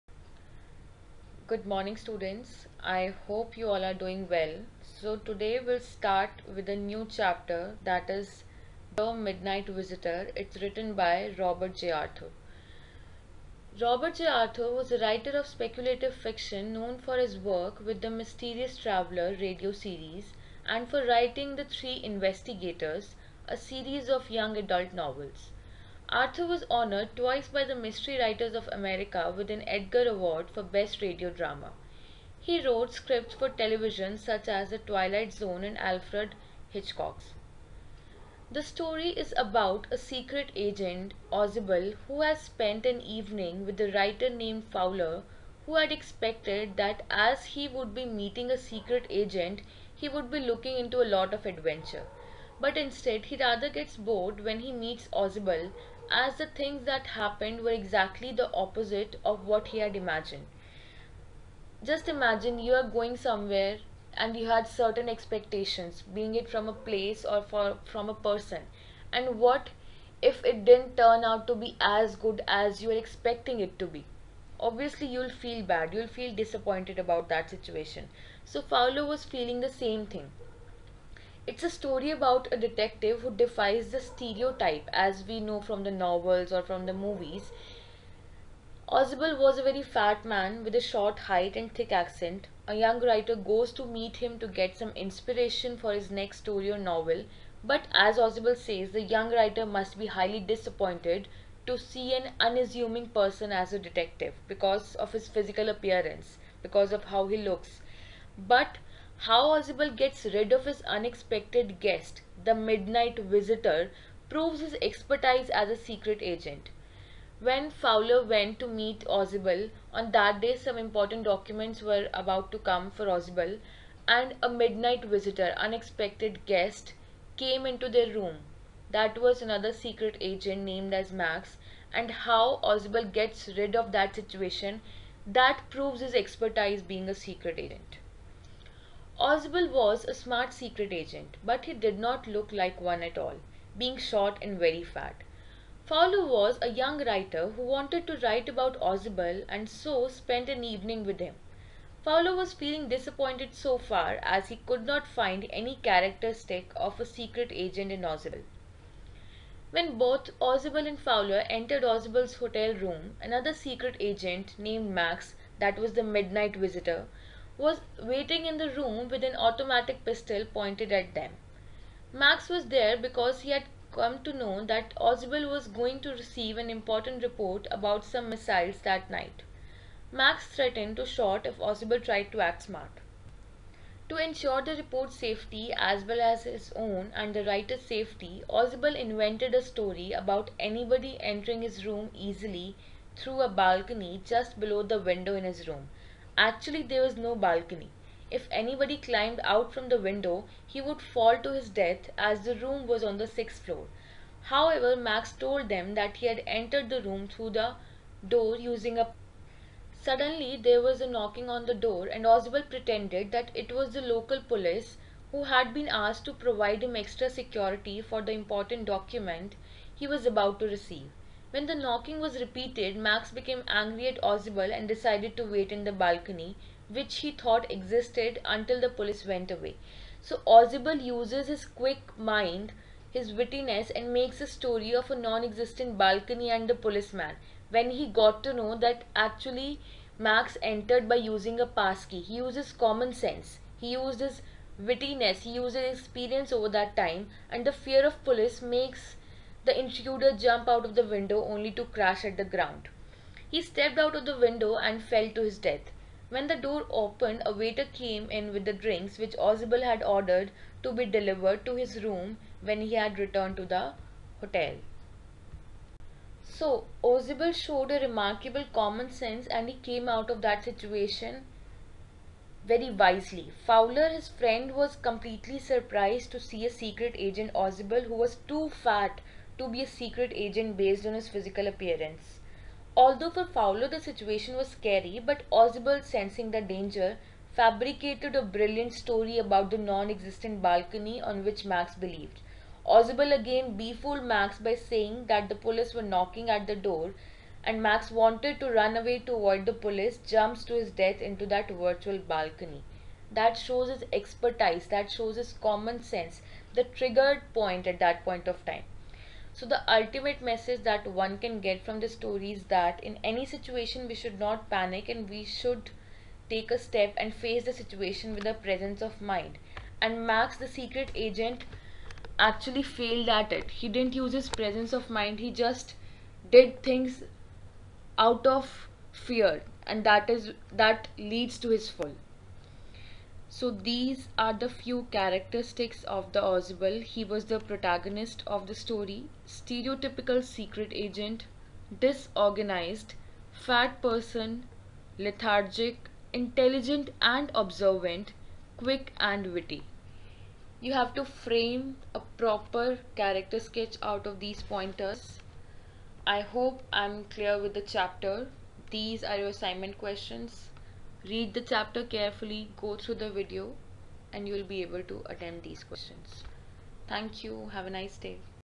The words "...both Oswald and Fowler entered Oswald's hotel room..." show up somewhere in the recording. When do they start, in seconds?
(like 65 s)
159 s.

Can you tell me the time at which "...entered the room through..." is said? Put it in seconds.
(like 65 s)
206 s.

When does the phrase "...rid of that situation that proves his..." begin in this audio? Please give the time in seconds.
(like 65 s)
133 s.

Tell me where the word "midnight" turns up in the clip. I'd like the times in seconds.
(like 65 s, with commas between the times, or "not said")
9 s, 112 s, 124 s, 166 s.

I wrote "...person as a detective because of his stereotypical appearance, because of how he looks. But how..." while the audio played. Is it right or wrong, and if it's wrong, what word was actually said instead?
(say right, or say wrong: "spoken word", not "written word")
wrong: "physical", not "stereotypical".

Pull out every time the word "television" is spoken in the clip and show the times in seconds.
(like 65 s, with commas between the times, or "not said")
33 s.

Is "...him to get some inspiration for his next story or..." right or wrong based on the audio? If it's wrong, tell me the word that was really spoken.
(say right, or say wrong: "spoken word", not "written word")
right.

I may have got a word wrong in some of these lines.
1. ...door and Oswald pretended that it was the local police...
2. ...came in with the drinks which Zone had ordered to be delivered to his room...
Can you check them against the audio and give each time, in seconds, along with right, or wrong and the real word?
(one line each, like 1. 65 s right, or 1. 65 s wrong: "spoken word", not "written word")
1. 211 s right
2. 257 s wrong: "Oswald", not "Zone".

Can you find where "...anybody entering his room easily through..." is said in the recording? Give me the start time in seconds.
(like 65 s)
190 s.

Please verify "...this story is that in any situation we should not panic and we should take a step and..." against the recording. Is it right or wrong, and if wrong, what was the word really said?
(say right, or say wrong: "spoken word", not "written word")
right.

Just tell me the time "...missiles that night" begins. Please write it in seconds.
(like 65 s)
178 s.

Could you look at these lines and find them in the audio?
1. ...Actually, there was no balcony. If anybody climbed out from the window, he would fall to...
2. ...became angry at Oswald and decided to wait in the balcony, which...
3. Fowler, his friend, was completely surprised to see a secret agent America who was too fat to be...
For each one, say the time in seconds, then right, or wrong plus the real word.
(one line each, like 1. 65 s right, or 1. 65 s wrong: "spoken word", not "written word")
1. 196 s right
2. 223 s right
3. 273 s wrong: "Oswald", not "America".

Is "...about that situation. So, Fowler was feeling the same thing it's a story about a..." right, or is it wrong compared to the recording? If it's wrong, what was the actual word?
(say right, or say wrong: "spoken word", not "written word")
right.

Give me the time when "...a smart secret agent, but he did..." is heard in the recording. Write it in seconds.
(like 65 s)
140 s.